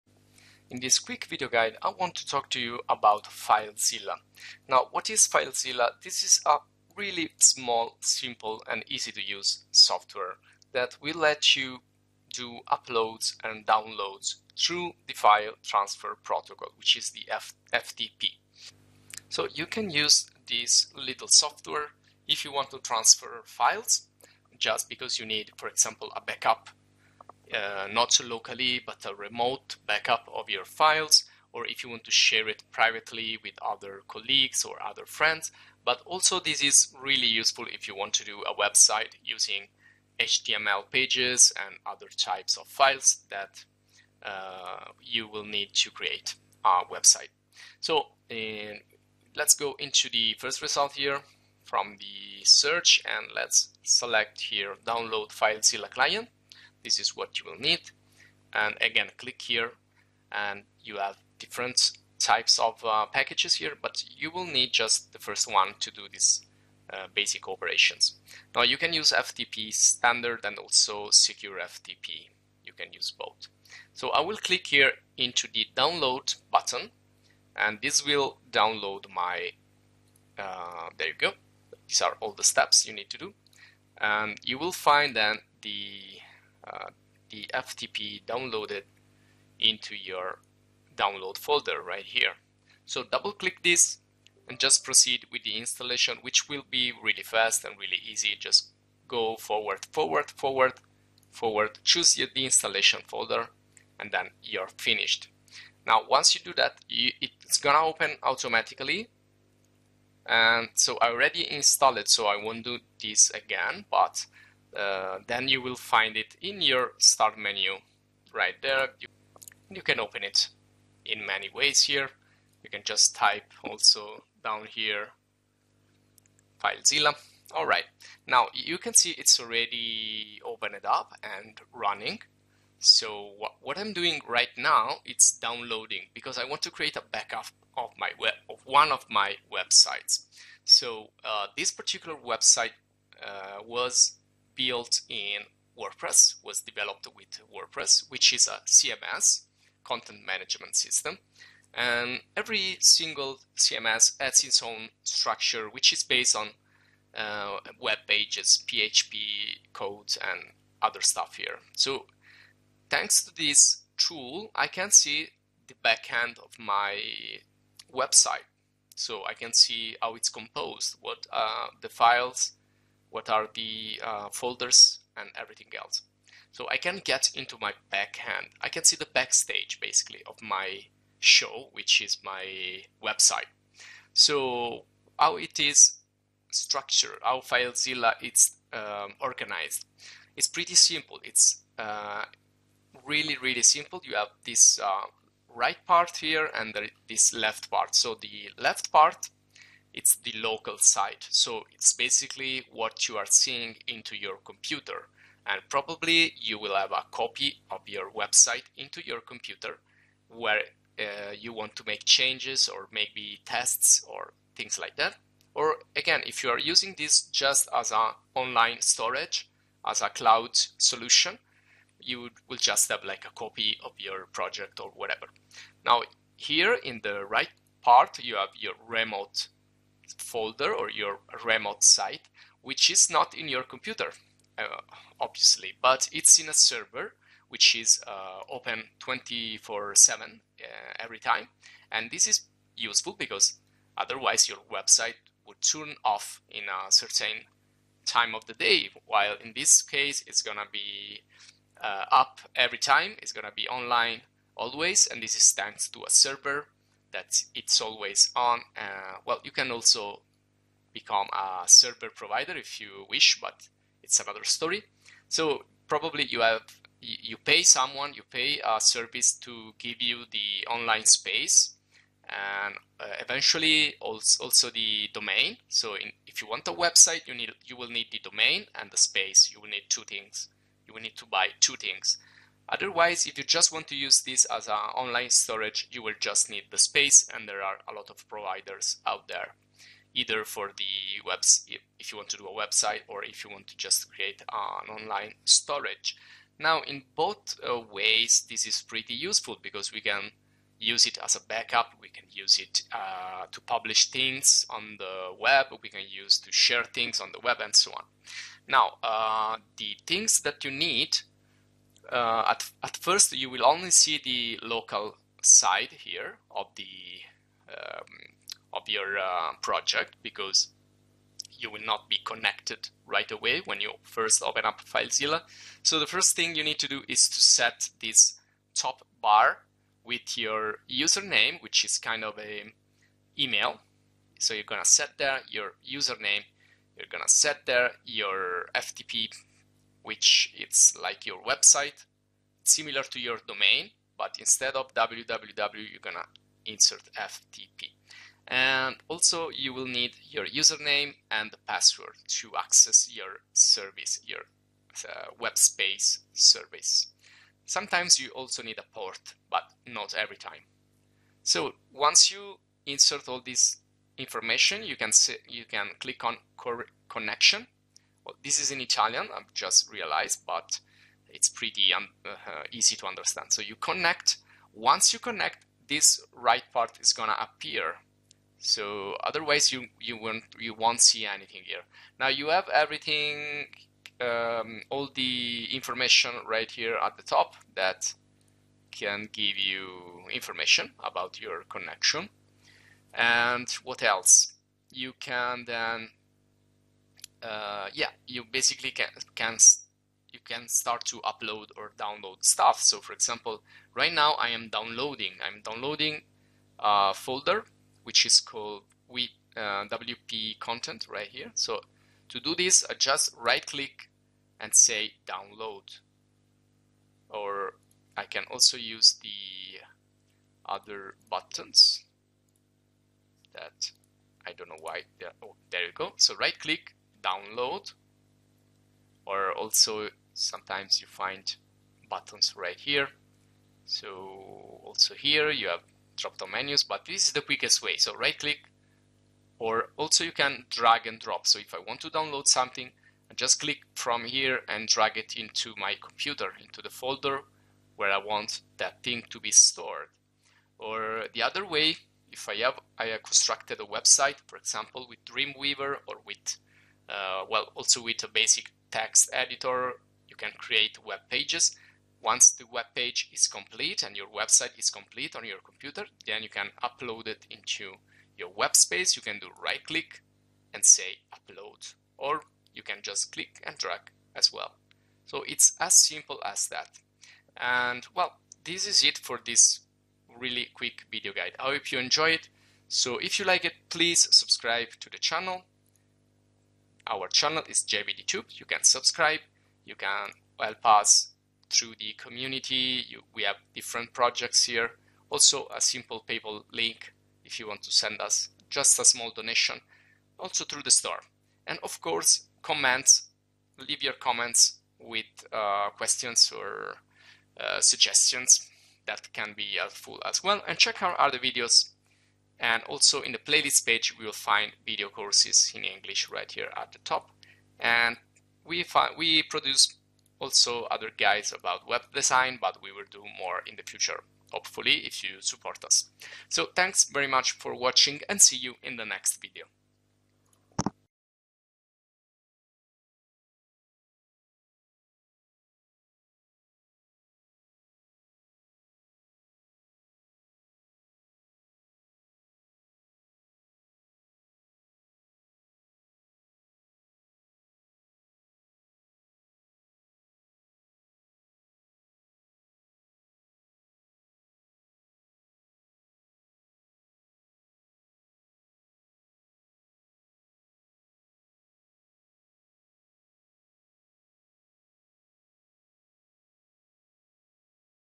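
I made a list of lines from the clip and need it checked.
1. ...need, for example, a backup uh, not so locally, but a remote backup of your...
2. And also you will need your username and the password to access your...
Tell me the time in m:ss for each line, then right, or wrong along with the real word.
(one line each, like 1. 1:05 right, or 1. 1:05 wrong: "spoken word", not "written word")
1. 0:25 right
2. 5:48 right.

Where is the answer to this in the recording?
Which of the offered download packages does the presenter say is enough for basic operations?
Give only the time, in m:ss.
1:05.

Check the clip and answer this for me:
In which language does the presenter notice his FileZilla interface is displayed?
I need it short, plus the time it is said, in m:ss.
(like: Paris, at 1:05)
Italian, at 6:08.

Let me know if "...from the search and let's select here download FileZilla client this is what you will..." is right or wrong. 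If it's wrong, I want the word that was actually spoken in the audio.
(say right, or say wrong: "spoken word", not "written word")
right.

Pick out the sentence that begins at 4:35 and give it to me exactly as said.
So in, if you want a website, you need you will need the domain and the space.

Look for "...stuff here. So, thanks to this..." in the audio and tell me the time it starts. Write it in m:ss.
2:41.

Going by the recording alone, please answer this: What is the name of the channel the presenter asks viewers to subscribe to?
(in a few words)
JBDTube.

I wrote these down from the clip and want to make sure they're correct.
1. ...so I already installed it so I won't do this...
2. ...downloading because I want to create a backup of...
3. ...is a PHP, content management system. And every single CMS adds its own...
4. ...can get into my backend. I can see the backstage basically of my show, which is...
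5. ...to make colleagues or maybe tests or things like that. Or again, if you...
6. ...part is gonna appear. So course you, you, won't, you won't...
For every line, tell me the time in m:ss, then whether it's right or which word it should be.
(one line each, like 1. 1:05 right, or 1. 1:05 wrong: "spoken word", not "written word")
1. 1:50 right
2. 2:15 right
3. 2:28 wrong: "CMS", not "PHP"
4. 2:56 right
5. 3:31 wrong: "changes", not "colleagues"
6. 6:16 wrong: "otherwise", not "course".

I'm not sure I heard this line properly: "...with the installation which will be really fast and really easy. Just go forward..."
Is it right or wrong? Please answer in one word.
right.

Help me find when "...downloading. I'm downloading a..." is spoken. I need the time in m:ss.
6:44.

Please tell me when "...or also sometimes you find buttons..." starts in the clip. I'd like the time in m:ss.
7:09.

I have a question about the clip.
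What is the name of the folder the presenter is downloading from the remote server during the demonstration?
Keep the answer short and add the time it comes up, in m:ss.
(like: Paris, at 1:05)
WP content, at 6:49.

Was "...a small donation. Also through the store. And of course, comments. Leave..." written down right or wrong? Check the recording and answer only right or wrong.
right.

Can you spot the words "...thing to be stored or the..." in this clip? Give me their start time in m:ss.
7:29.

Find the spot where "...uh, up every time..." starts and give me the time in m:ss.
4:11.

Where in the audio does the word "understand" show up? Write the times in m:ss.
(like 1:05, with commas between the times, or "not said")
6:13.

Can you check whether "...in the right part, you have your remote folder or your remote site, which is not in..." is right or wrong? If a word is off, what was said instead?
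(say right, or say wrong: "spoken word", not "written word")
right.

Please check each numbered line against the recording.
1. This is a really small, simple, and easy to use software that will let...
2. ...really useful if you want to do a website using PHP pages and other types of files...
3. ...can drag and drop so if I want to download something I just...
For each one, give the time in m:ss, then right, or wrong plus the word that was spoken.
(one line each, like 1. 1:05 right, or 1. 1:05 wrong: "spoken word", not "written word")
1. 0:06 right
2. 0:37 wrong: "HTML", not "PHP"
3. 7:20 right.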